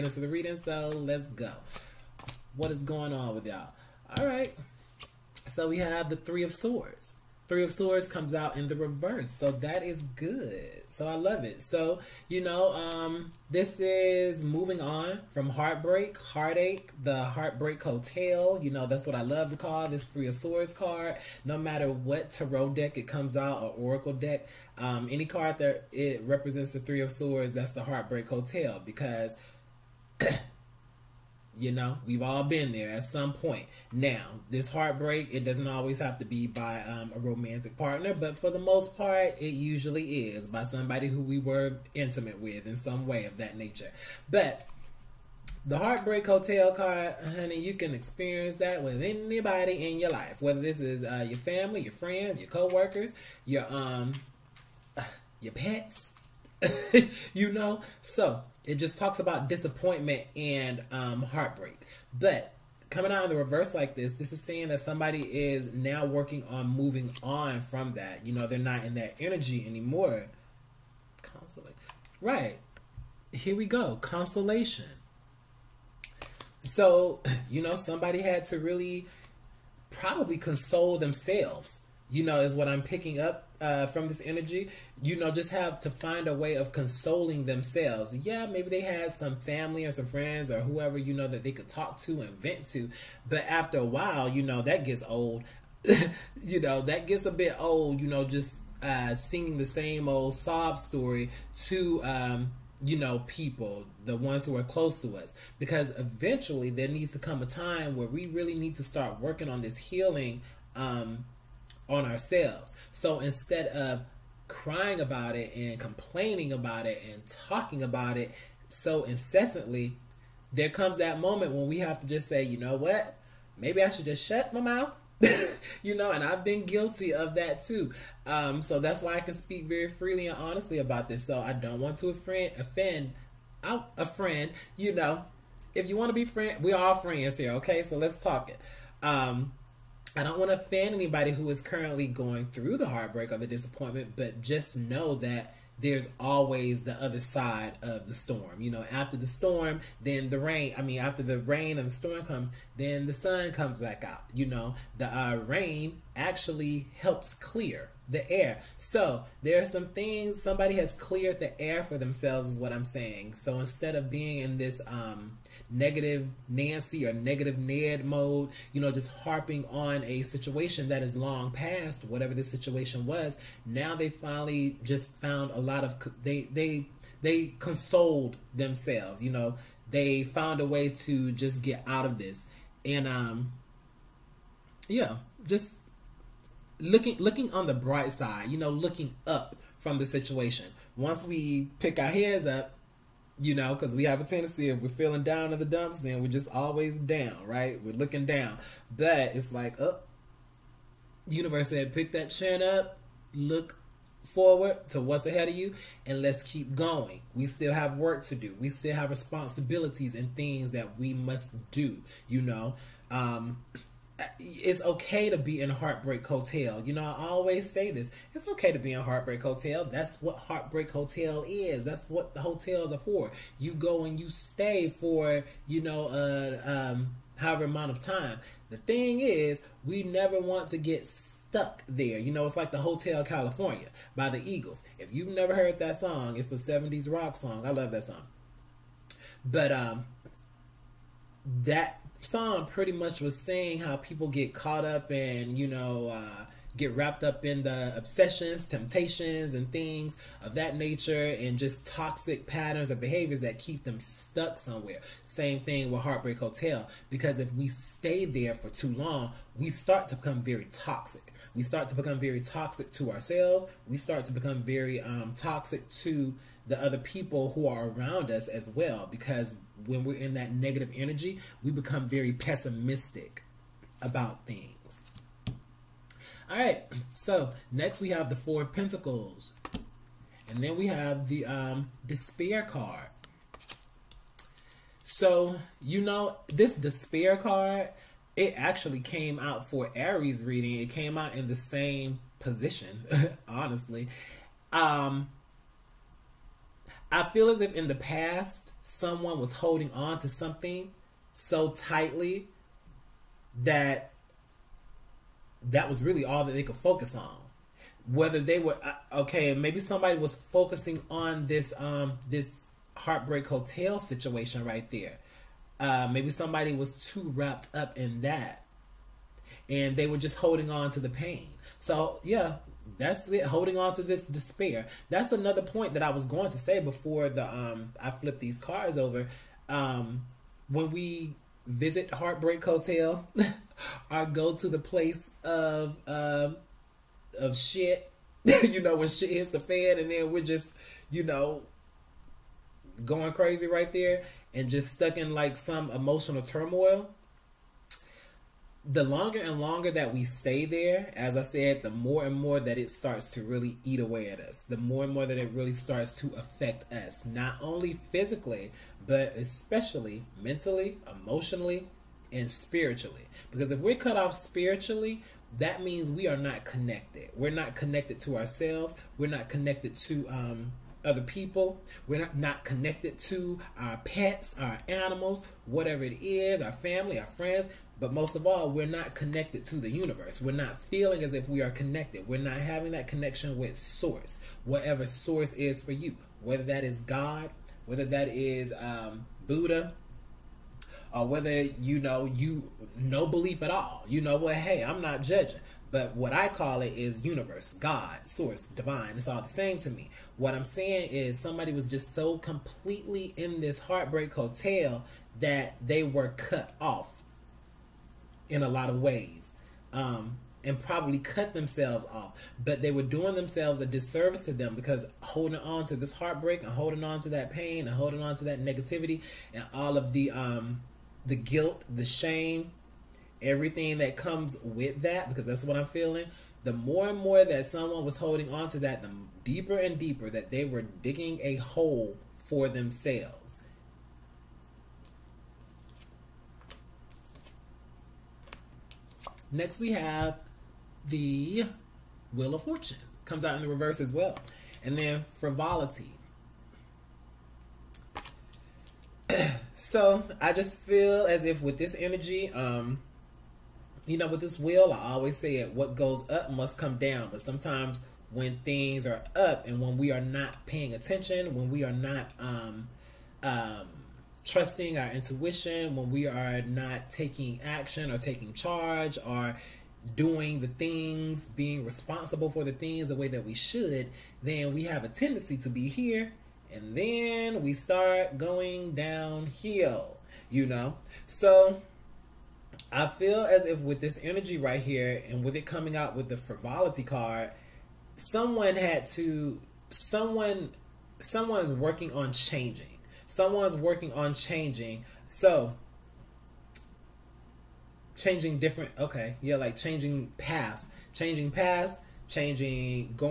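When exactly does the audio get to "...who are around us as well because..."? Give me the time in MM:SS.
04:27.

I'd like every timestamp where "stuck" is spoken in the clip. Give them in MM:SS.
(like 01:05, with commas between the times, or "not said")
03:51, 04:13, 05:44.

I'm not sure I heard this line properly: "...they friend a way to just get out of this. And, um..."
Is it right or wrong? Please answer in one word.
wrong.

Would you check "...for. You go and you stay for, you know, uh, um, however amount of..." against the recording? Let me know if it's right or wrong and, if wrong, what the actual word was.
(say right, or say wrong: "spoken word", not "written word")
right.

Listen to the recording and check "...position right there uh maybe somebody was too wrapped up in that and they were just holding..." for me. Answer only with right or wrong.
wrong.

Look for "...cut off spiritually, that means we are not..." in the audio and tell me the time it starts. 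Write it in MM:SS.
06:03.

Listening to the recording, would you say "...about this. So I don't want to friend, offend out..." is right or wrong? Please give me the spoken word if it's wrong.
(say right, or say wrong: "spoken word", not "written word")
wrong: "offend", not "friend".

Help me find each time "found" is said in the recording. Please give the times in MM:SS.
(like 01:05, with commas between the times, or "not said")
02:55, 03:00.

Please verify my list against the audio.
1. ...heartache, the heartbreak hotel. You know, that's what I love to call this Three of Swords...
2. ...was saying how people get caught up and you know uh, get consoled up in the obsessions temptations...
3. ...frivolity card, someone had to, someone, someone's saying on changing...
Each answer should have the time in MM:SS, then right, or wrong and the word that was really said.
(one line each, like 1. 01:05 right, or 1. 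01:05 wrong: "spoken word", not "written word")
1. 00:16 right
2. 04:03 wrong: "wrapped", not "consoled"
3. 08:06 wrong: "working", not "saying".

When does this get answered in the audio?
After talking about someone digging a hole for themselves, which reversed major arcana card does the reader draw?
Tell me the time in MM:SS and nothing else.
07:22.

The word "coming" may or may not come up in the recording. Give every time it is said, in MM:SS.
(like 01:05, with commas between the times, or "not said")
01:02, 08:05.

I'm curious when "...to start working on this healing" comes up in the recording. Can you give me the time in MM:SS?
01:48.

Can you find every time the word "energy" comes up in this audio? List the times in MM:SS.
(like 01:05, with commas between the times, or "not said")
01:09, 01:24, 04:30, 07:31, 08:04.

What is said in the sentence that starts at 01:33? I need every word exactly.
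But after a while, you know, that gets old.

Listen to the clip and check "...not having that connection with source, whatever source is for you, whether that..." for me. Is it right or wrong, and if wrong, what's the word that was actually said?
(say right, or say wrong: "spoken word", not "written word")
right.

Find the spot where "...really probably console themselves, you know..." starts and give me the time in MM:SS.
01:18.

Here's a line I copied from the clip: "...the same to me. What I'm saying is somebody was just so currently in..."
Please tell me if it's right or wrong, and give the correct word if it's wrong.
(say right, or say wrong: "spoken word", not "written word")
wrong: "completely", not "currently".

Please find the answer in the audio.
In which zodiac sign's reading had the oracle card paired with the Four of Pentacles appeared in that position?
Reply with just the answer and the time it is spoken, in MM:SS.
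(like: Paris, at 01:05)
Aries, at 04:49.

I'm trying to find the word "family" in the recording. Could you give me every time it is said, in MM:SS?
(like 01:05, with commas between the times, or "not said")
00:51, 01:29, 06:16.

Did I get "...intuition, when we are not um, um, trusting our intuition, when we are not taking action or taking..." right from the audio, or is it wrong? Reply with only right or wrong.
wrong.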